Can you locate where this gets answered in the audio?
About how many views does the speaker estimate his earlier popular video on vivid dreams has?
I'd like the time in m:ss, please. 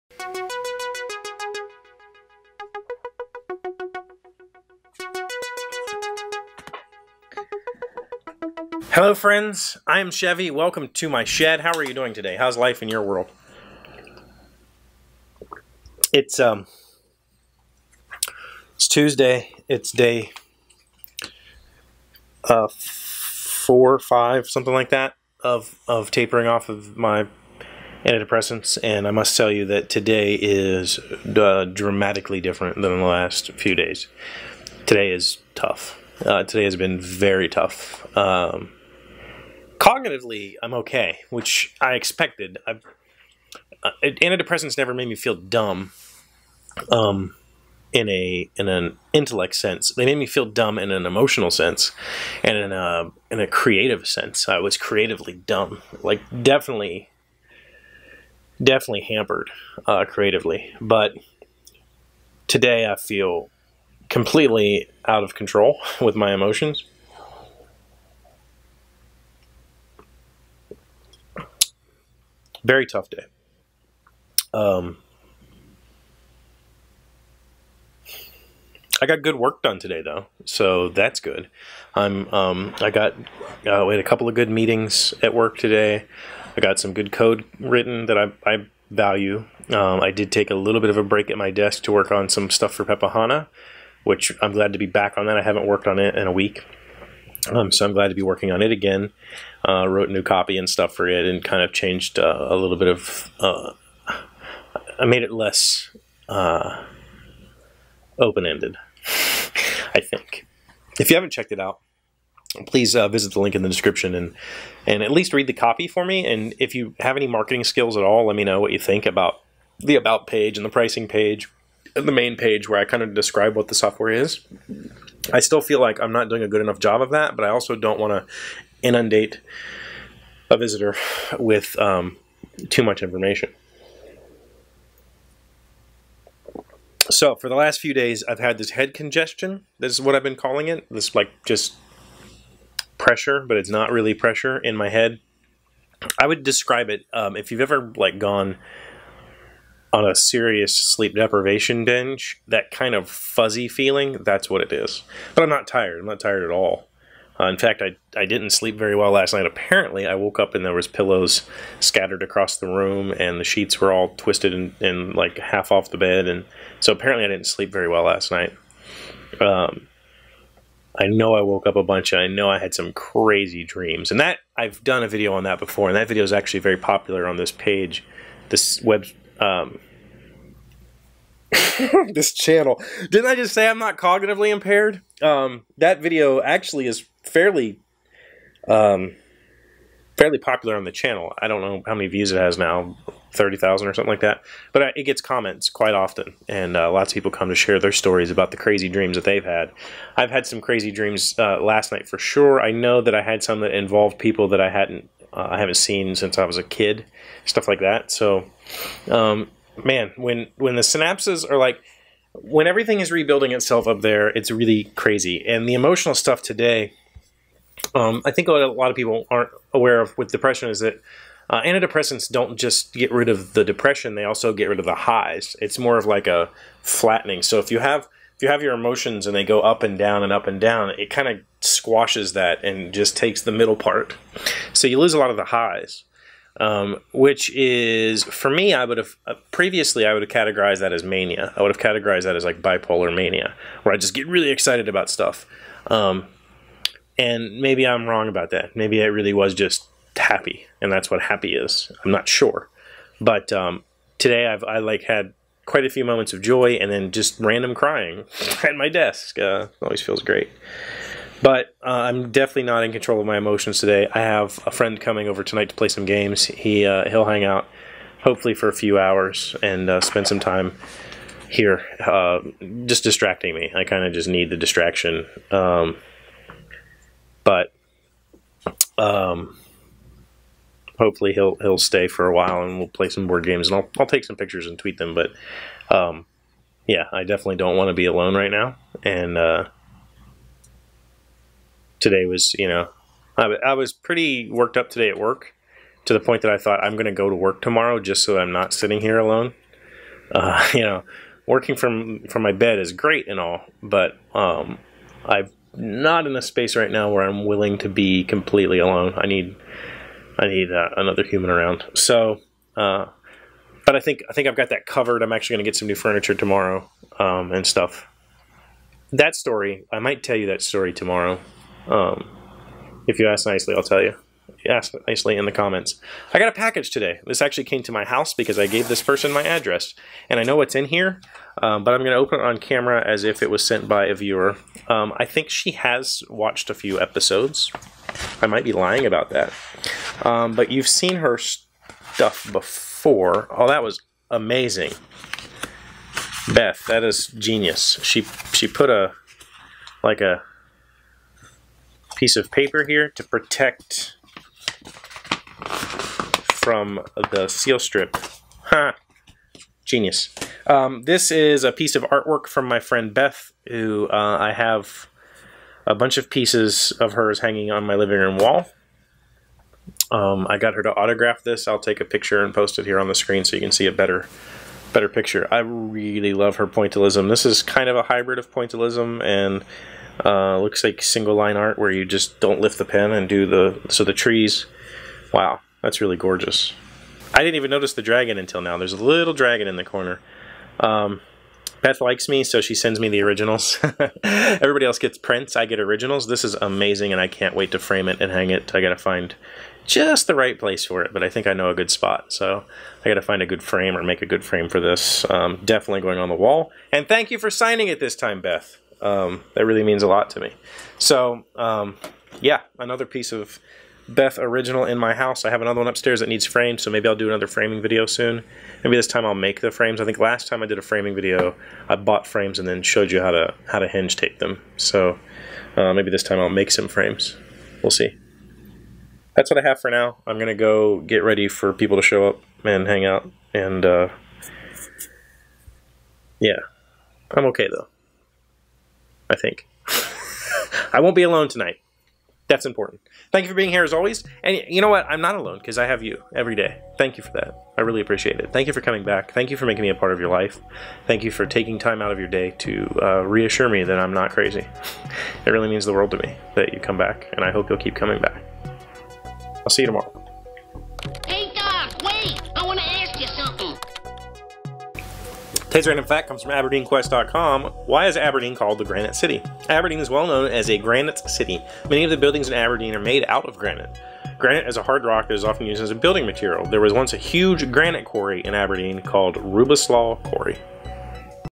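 3:13.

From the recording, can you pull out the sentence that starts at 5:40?
Um, but you've seen her stuff before.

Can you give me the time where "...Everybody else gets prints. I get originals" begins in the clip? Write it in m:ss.
6:34.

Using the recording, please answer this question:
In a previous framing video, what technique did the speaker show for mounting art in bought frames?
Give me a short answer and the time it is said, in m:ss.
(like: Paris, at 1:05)
hinge tape, at 7:03.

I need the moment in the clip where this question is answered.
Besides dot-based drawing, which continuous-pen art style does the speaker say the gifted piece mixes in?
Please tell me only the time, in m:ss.
6:21.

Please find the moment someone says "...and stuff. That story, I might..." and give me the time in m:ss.
5:17.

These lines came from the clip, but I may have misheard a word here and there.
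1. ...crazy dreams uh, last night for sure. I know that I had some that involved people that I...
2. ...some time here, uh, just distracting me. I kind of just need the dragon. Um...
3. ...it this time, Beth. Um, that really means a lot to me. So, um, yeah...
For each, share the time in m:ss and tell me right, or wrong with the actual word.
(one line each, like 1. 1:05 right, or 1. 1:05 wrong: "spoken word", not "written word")
1. 3:20 right
2. 4:30 wrong: "distraction", not "dragon"
3. 6:47 right.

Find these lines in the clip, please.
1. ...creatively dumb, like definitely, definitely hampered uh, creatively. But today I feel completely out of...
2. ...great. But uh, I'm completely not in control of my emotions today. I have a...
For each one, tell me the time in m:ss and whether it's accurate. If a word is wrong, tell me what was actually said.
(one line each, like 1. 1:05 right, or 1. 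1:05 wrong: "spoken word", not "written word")
1. 0:54 right
2. 4:20 wrong: "definitely", not "completely".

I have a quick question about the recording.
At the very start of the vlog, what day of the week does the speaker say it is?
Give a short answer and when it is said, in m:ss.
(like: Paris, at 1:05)
Tuesday, at 0:18.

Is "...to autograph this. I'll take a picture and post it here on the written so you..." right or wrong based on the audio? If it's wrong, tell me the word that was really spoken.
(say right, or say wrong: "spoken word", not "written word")
wrong: "screen", not "written".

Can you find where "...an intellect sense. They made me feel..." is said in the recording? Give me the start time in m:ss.
0:48.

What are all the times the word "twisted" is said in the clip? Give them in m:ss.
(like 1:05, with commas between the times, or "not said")
2:44.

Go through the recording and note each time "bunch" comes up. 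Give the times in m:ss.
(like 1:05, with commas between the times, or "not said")
2:51, 6:05.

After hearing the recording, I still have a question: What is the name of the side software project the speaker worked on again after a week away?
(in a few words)
Pepahana.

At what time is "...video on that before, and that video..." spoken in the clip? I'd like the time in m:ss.
2:55.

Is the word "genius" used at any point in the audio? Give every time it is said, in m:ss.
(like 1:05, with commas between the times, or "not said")
5:47, 5:59.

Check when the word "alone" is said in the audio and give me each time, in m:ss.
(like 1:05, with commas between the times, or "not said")
4:48, 4:59, 5:08, 7:21, 7:25.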